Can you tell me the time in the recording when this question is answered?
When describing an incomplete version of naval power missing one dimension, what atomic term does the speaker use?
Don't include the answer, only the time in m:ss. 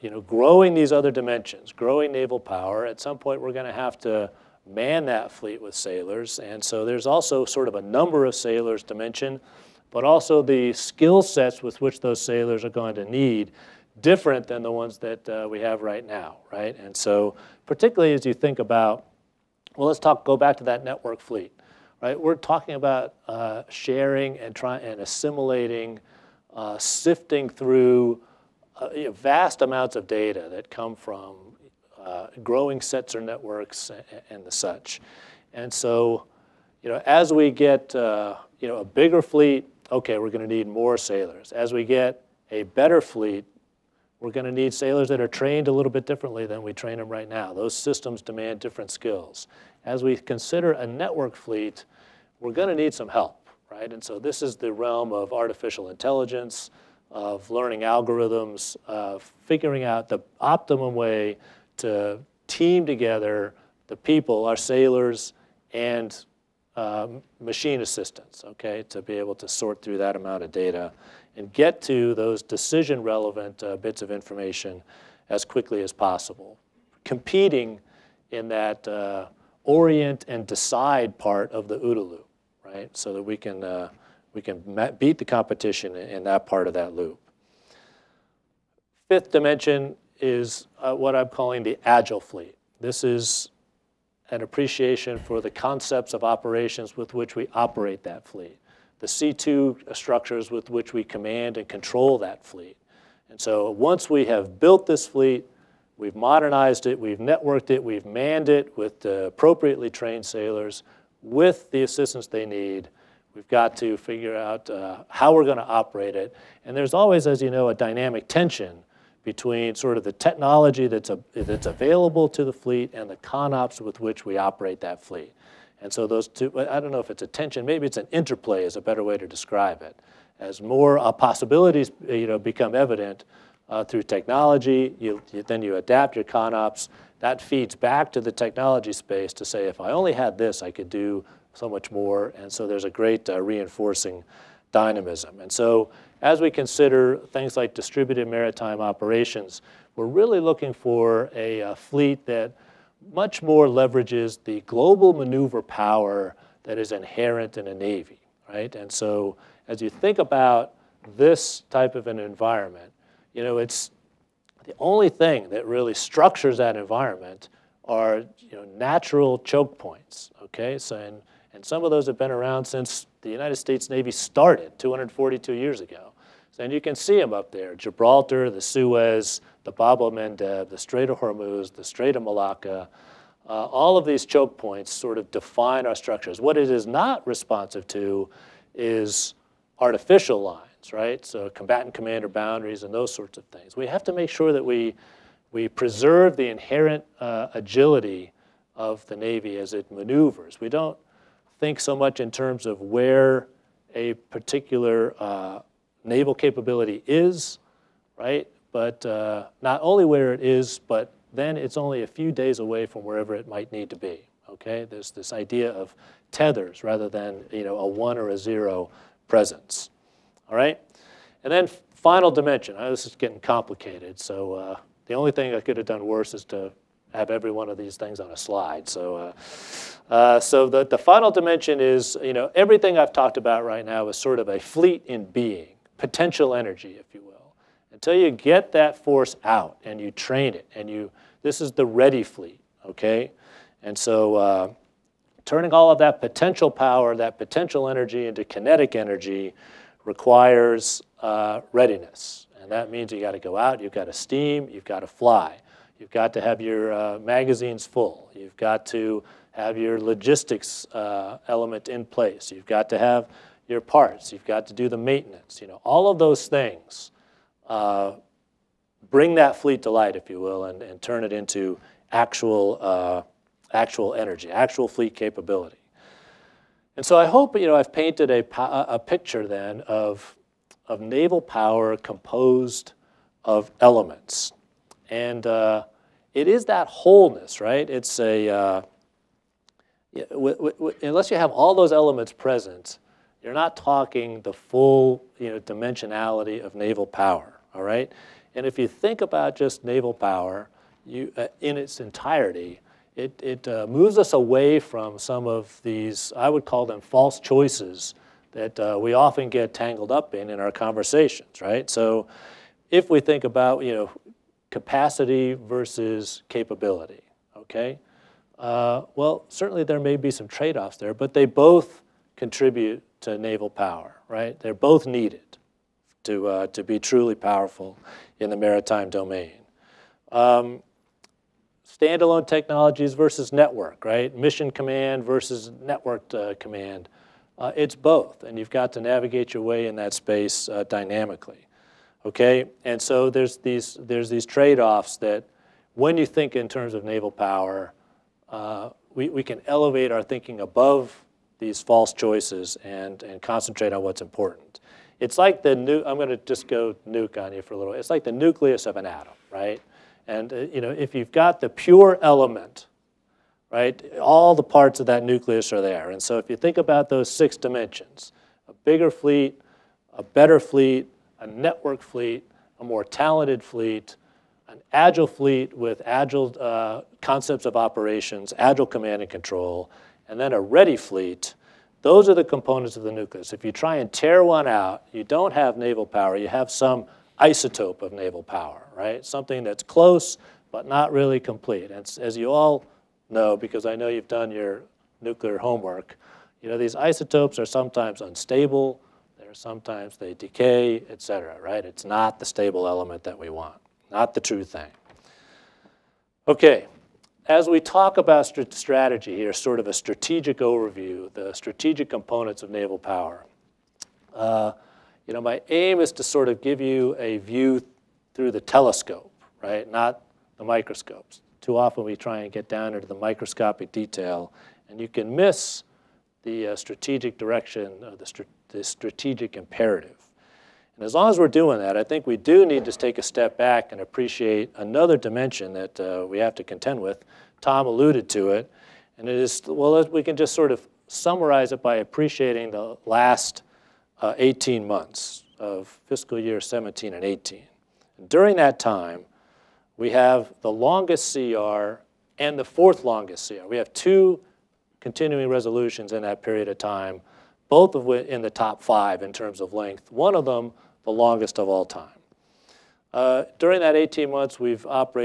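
6:27.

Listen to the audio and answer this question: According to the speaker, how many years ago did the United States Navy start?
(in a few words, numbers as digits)
242.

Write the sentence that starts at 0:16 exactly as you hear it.
And so particularly as you think about, well, let's talk, go back to that network fleet right?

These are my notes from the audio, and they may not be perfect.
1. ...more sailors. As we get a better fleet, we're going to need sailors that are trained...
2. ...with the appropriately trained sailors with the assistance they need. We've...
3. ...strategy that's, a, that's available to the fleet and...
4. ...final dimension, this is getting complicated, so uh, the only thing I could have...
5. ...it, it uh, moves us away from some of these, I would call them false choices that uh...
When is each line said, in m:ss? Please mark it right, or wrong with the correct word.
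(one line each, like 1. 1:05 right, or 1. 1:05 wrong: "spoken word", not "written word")
1. 0:40 right
2. 1:48 right
3. 2:00 wrong: "technology", not "strategy"
4. 3:41 right
5. 5:03 right.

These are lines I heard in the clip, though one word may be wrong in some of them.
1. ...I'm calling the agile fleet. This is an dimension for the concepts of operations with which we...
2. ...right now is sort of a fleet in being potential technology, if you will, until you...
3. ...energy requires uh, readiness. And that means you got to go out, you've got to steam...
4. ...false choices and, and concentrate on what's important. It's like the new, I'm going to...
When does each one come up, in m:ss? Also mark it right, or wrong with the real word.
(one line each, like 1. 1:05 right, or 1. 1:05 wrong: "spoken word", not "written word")
1. 1:31 wrong: "appreciation", not "dimension"
2. 3:53 wrong: "energy", not "technology"
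3. 4:08 right
4. 5:51 right.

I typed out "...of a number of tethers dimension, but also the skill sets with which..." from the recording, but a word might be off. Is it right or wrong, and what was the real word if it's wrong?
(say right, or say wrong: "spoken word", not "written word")
wrong: "sailors", not "tethers".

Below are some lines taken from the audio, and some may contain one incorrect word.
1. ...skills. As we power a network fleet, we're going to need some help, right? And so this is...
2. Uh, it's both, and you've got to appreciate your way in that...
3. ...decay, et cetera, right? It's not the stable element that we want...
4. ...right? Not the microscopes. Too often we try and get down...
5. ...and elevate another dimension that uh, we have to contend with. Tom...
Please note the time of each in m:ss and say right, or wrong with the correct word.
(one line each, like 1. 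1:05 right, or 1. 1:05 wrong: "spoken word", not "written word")
1. 0:48 wrong: "consider", not "power"
2. 5:37 wrong: "navigate", not "appreciate"
3. 6:40 right
4. 6:59 right
5. 7:13 wrong: "appreciate", not "elevate".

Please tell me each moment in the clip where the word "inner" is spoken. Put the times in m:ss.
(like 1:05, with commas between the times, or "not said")
not said.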